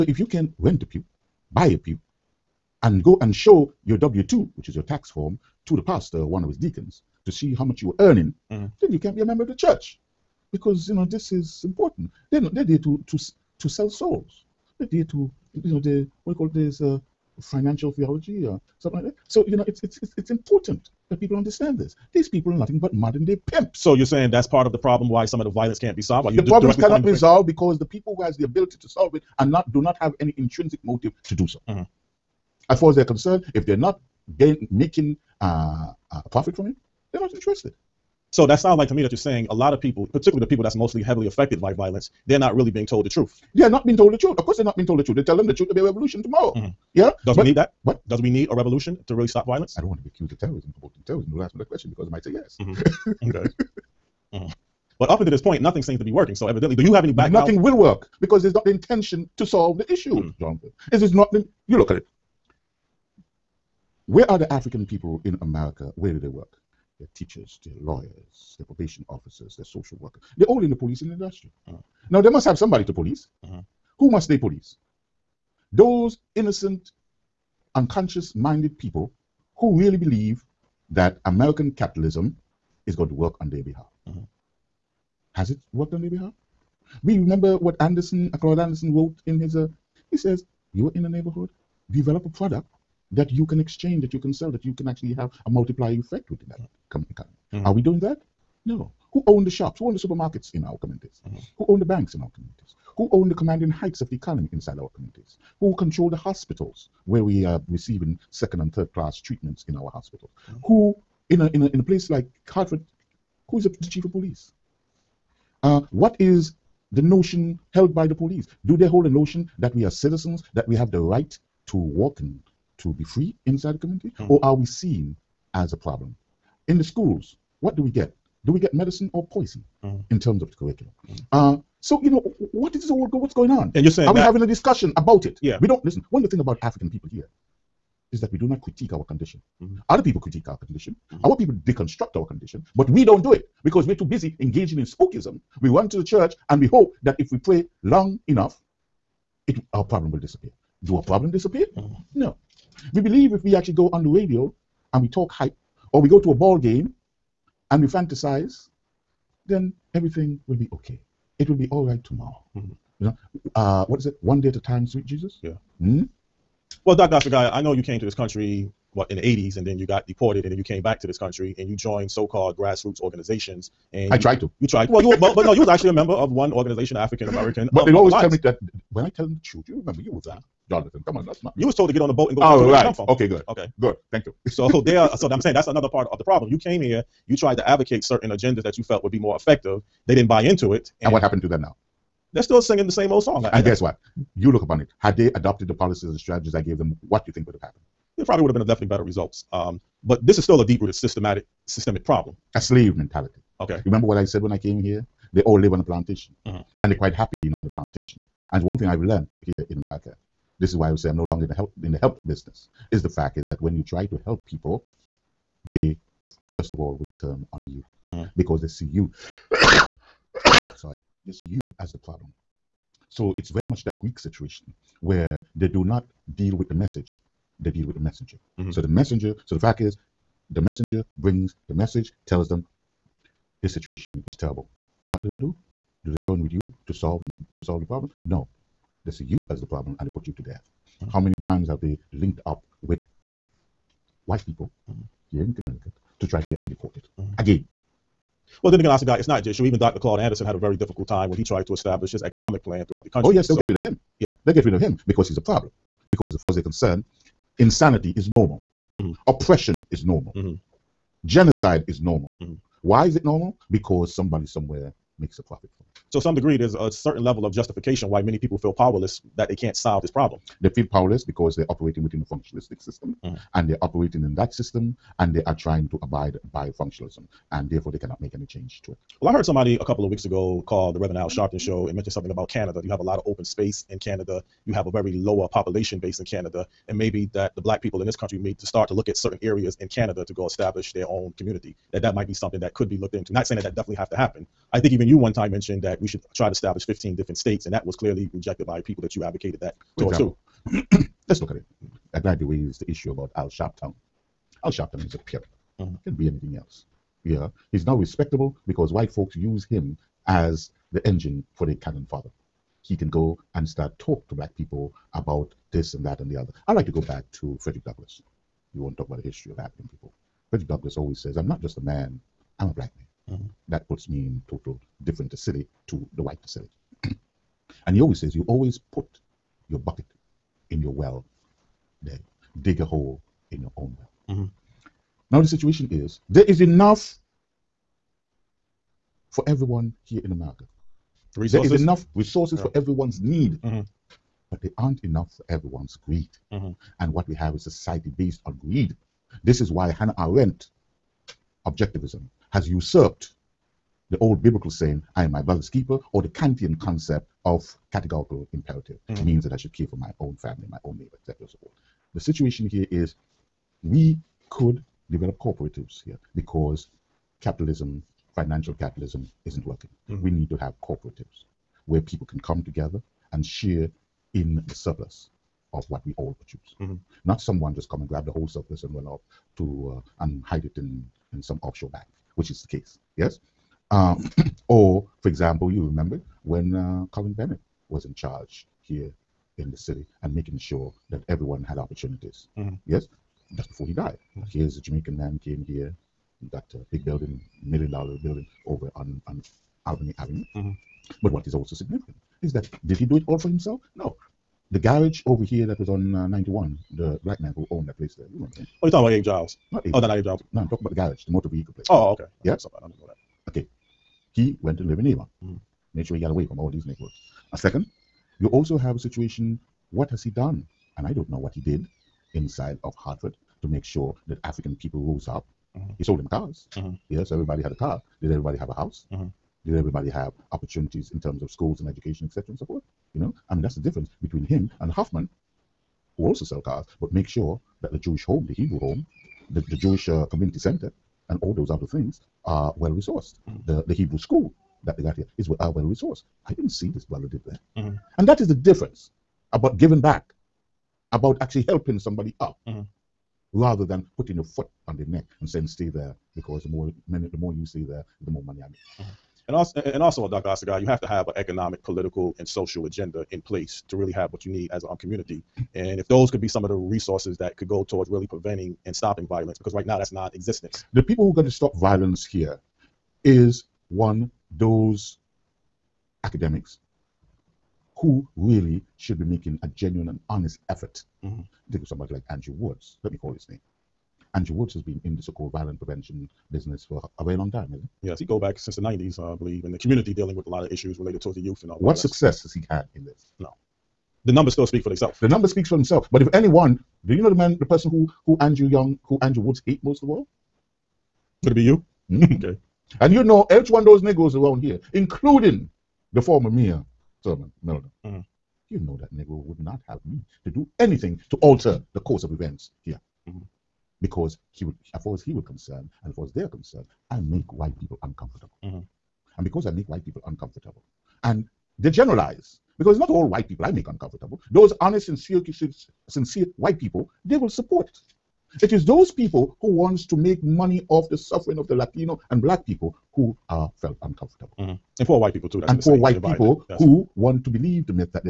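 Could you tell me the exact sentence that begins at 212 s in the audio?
Is the fact is that when you try to help people, they first of all will turn on you mm -hmm.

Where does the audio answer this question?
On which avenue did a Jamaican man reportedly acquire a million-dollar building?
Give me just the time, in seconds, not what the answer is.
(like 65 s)
399 s.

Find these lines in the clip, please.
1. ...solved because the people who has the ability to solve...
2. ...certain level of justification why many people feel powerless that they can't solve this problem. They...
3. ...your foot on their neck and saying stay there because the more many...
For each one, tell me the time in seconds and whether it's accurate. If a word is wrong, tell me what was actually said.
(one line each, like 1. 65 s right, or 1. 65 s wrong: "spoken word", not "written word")
1. 27 s right
2. 266 s right
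3. 454 s right.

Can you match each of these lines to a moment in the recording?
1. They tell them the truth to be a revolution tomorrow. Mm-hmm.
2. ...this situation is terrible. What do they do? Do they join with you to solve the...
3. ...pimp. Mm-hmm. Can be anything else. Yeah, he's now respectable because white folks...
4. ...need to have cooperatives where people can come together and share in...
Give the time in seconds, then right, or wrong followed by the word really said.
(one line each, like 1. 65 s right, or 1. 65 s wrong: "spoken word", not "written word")
1. 45 s right
2. 233 s right
3. 305 s right
4. 370 s right.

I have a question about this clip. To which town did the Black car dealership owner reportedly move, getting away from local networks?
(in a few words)
Avon.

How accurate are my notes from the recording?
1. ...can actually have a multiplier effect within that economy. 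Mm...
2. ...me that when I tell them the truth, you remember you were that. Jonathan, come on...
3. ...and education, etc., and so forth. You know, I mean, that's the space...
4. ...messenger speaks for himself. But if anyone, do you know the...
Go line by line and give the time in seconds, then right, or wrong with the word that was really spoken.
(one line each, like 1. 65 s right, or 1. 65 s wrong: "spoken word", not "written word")
1. 94 s right
2. 178 s right
3. 431 s wrong: "difference", not "space"
4. 495 s wrong: "number", not "messenger".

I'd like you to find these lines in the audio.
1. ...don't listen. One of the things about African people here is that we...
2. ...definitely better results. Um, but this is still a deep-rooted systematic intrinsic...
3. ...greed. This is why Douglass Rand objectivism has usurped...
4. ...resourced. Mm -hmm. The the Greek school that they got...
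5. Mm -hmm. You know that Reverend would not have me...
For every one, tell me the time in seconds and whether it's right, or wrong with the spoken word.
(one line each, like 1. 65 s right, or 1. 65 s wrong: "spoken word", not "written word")
1. 135 s right
2. 198 s wrong: "systemic", not "intrinsic"
3. 348 s wrong: "Ayn", not "Douglass"
4. 442 s wrong: "Hebrew", not "Greek"
5. 508 s wrong: "Negro", not "Reverend".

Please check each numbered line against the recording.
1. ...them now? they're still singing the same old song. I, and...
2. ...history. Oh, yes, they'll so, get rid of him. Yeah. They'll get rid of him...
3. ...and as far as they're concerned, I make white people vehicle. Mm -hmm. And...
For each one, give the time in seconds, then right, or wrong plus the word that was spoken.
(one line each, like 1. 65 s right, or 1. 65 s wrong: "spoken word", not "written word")
1. 191 s right
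2. 253 s wrong: "country", not "history"
3. 516 s wrong: "uncomfortable", not "vehicle".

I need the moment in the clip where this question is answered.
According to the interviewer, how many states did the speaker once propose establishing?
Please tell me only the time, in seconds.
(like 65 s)
296 s.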